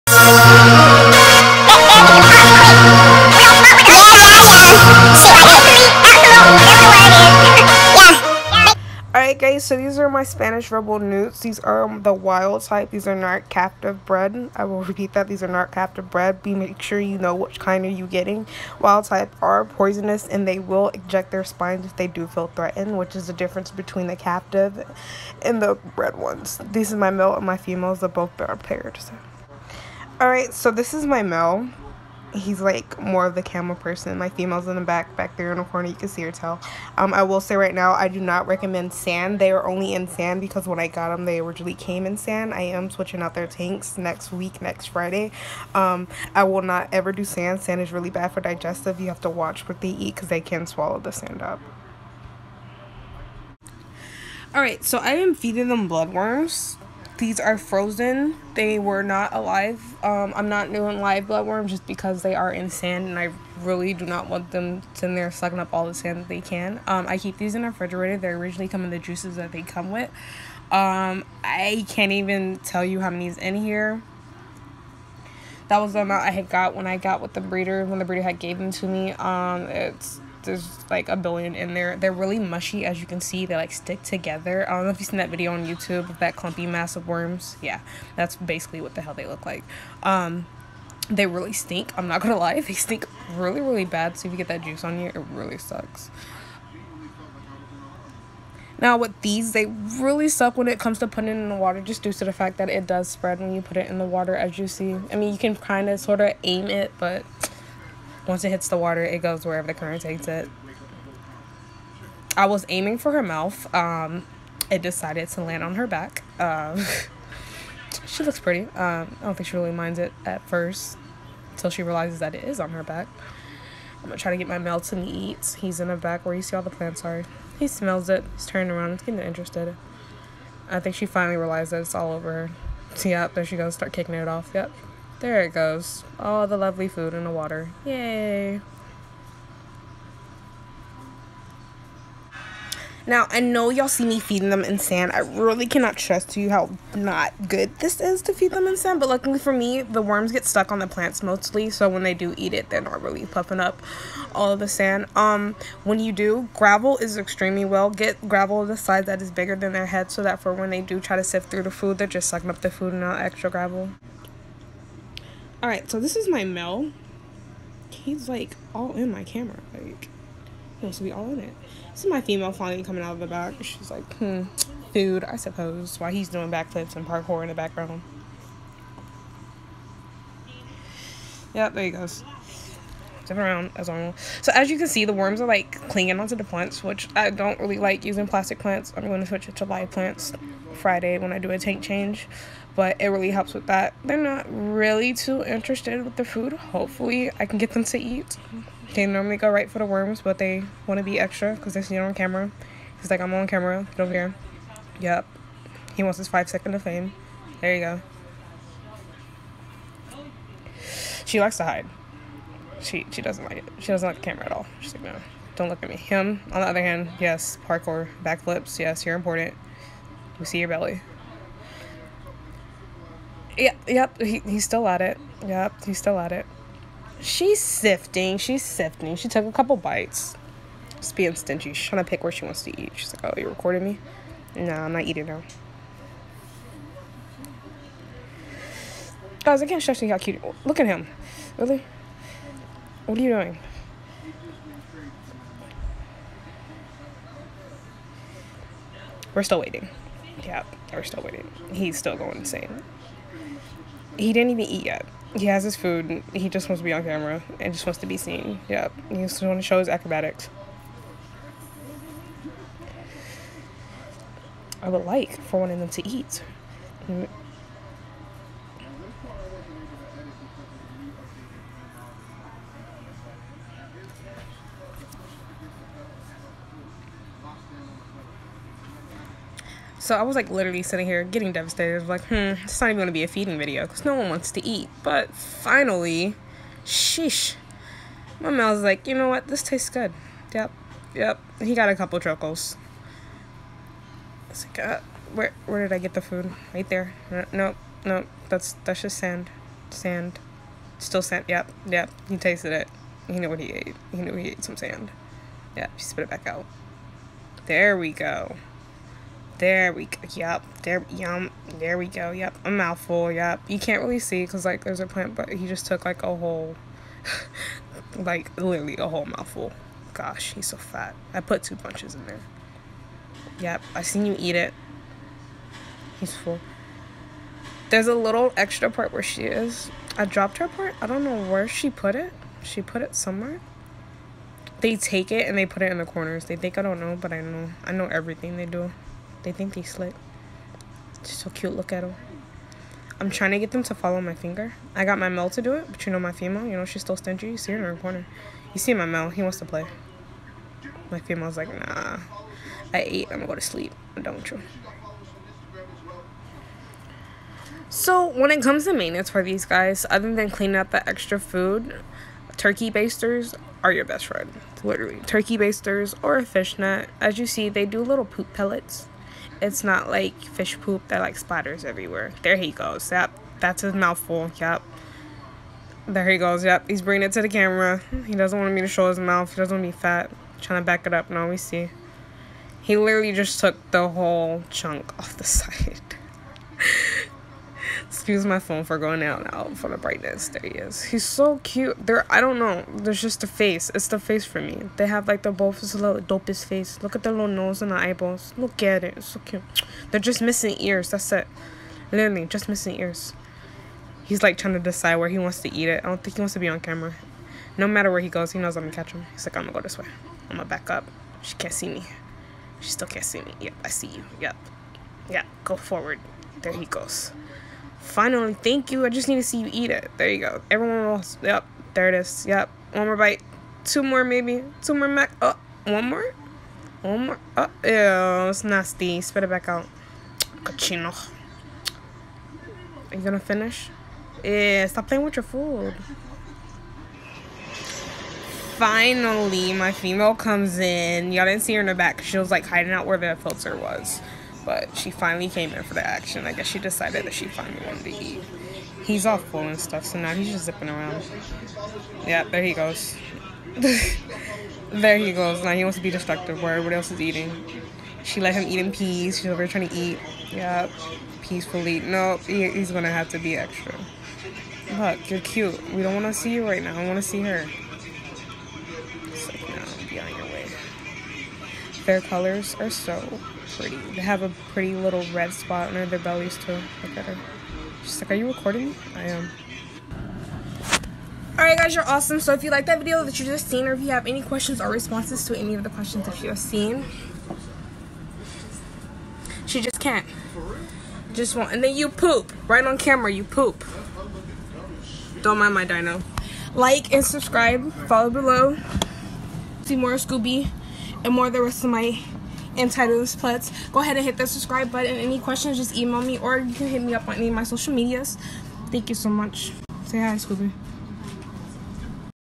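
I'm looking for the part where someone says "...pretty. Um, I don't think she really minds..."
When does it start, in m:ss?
1:58.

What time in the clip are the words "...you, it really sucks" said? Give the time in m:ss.
1:34.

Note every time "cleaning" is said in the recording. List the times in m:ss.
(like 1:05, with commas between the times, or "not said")
6:00.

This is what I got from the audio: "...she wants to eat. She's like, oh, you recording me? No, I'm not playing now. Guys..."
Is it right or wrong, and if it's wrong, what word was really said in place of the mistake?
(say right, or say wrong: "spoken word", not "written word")
wrong: "eating", not "playing".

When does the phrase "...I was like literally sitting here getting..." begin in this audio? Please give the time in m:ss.
4:40.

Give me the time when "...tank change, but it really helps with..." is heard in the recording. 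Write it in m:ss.
3:11.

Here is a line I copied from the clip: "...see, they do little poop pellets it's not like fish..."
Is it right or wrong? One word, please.
right.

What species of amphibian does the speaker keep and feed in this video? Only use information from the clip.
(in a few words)
Spanish Ripple Newts.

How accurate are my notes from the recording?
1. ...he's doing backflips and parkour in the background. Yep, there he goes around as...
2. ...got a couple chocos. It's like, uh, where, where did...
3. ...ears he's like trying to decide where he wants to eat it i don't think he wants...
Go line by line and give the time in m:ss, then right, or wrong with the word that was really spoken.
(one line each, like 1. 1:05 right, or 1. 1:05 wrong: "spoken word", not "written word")
1. 2:56 right
2. 4:51 right
3. 6:42 right.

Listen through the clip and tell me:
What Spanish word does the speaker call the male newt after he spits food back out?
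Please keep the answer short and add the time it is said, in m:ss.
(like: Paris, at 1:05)
Cochino, at 7:10.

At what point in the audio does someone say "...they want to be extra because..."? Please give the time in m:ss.
3:20.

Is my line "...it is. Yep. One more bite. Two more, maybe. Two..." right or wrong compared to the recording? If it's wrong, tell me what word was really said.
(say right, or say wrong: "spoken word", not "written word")
right.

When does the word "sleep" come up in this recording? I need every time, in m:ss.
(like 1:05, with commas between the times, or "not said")
5:53.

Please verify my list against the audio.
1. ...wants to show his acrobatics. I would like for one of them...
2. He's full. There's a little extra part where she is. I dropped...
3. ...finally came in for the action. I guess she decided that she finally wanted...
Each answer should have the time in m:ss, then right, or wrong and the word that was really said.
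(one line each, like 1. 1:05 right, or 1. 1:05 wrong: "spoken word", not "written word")
1. 4:19 right
2. 5:26 right
3. 7:25 right.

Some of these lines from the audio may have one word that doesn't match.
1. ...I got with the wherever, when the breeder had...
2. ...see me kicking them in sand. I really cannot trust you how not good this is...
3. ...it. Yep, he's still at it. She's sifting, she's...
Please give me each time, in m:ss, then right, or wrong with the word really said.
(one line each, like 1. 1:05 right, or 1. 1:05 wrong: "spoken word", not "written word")
1. 1:16 wrong: "breeder", not "wherever"
2. 2:23 wrong: "feeding", not "kicking"
3. 3:45 right.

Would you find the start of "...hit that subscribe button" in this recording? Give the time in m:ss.
8:24.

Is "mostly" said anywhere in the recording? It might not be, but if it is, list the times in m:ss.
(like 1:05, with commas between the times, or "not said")
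2:31.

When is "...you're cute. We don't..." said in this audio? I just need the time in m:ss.
7:45.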